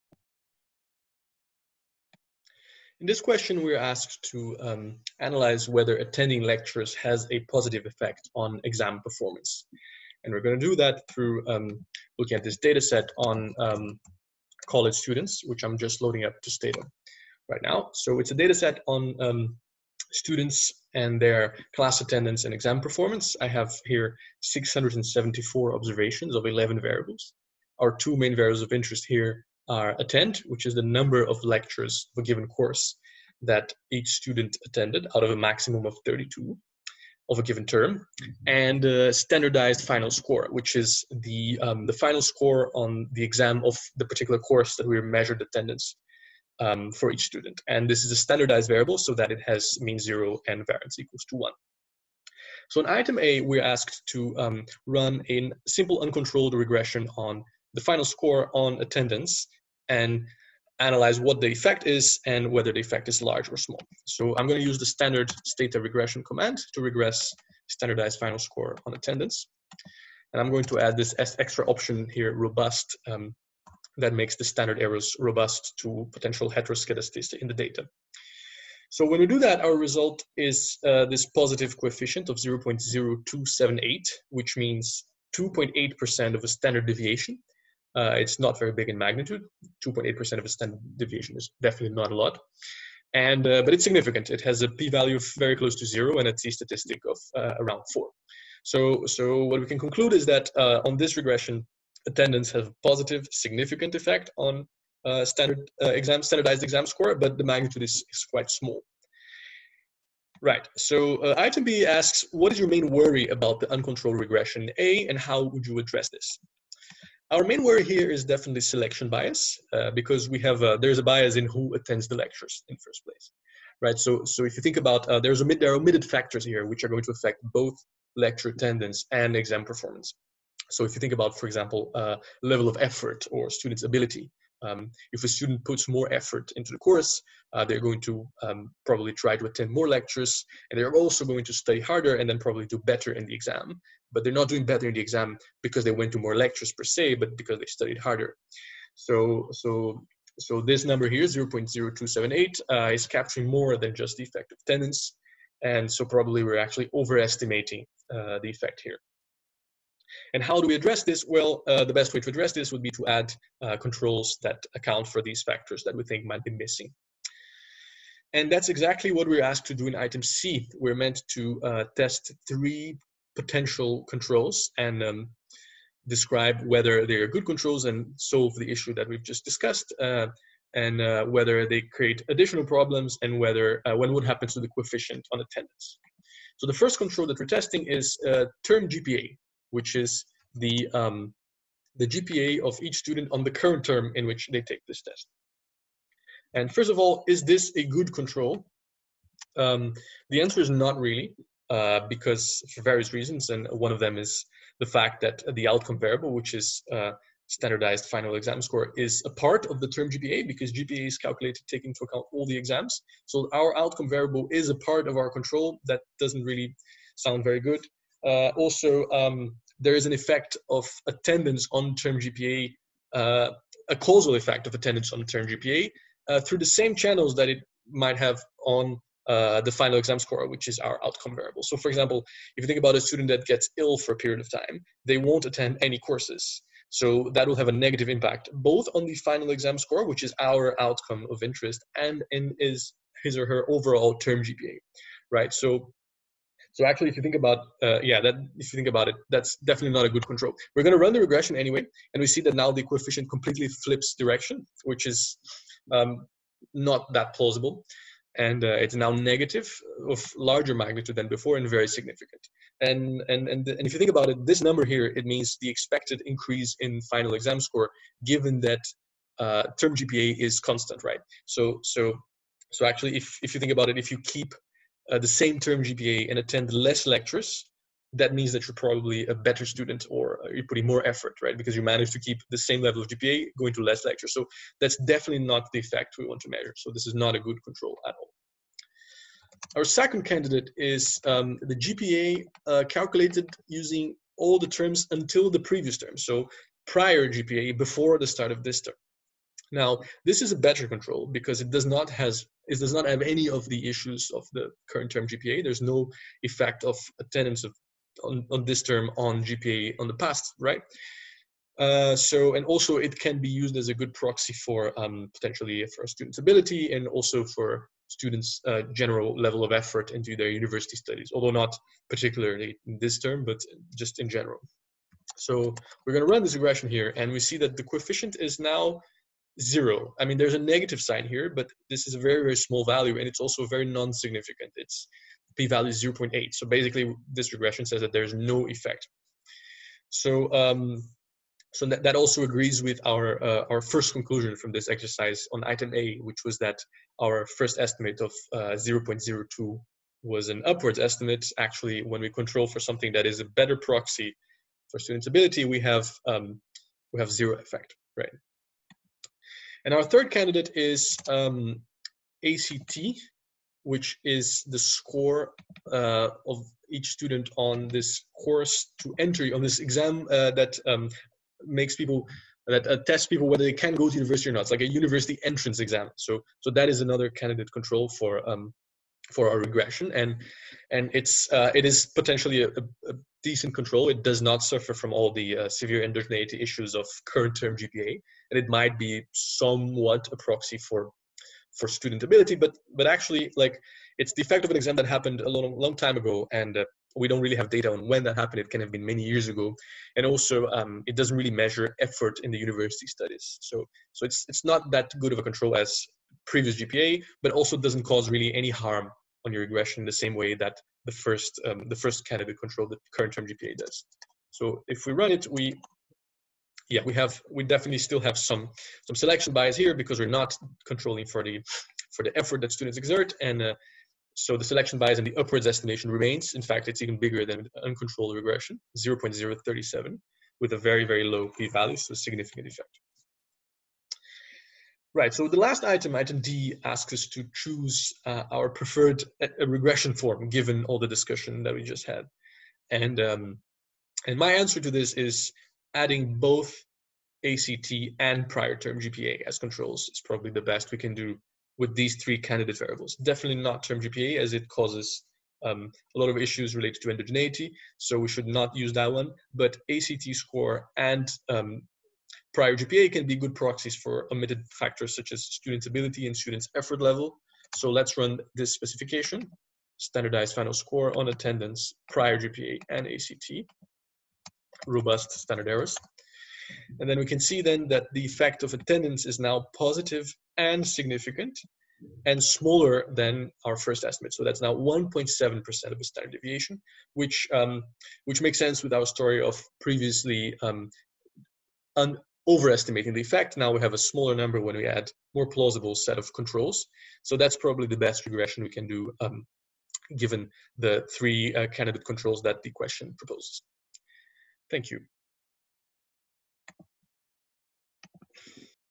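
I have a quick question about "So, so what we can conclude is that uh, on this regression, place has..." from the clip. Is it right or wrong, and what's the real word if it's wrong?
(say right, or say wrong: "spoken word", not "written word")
wrong: "attendance", not "place".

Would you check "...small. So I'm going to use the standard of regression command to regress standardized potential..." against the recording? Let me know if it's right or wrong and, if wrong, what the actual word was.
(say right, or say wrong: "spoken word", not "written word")
wrong: "final", not "potential".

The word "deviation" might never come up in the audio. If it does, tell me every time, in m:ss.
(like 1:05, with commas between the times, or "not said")
1:26, 1:30, 8:06.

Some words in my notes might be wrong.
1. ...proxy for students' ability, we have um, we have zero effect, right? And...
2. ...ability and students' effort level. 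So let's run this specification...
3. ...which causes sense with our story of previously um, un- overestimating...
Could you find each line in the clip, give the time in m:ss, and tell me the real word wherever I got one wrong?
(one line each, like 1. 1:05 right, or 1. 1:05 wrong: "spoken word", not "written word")
1. 5:53 right
2. 7:45 right
3. 8:08 wrong: "makes", not "causes".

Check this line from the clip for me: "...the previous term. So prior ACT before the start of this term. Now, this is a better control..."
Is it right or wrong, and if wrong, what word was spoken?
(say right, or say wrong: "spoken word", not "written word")
wrong: "GPA", not "ACT".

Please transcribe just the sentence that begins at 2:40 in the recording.
And how do we address this?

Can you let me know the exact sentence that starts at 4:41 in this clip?
Because you manage to keep the same level of GPA going to less lectures.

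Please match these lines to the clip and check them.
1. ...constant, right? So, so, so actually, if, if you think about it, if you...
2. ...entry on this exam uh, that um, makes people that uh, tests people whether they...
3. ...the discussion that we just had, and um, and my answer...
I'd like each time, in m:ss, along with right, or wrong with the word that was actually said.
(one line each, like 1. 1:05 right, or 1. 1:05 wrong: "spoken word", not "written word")
1. 4:30 right
2. 6:09 right
3. 7:20 right.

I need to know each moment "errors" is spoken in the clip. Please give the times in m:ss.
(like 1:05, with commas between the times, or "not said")
1:14, 7:55.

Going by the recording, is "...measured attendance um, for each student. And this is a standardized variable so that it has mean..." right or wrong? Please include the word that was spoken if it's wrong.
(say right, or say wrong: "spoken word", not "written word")
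right.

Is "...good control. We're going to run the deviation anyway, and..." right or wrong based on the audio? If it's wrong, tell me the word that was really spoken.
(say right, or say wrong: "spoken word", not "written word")
wrong: "regression", not "deviation".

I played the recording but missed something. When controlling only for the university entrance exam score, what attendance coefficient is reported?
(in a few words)
0.037.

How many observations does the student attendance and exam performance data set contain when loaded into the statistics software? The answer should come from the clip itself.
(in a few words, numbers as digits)
674.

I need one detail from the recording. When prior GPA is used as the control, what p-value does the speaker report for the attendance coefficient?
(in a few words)
0.8.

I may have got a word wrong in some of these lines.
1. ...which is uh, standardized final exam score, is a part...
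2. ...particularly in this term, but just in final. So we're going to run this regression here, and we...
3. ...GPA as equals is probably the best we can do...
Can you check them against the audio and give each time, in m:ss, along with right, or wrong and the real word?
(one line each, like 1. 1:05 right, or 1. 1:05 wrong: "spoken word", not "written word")
1. 3:26 right
2. 5:22 wrong: "general", not "final"
3. 7:28 wrong: "controls", not "equals".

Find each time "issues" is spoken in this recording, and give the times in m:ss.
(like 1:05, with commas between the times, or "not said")
2:58, 5:03, 6:26, 7:36.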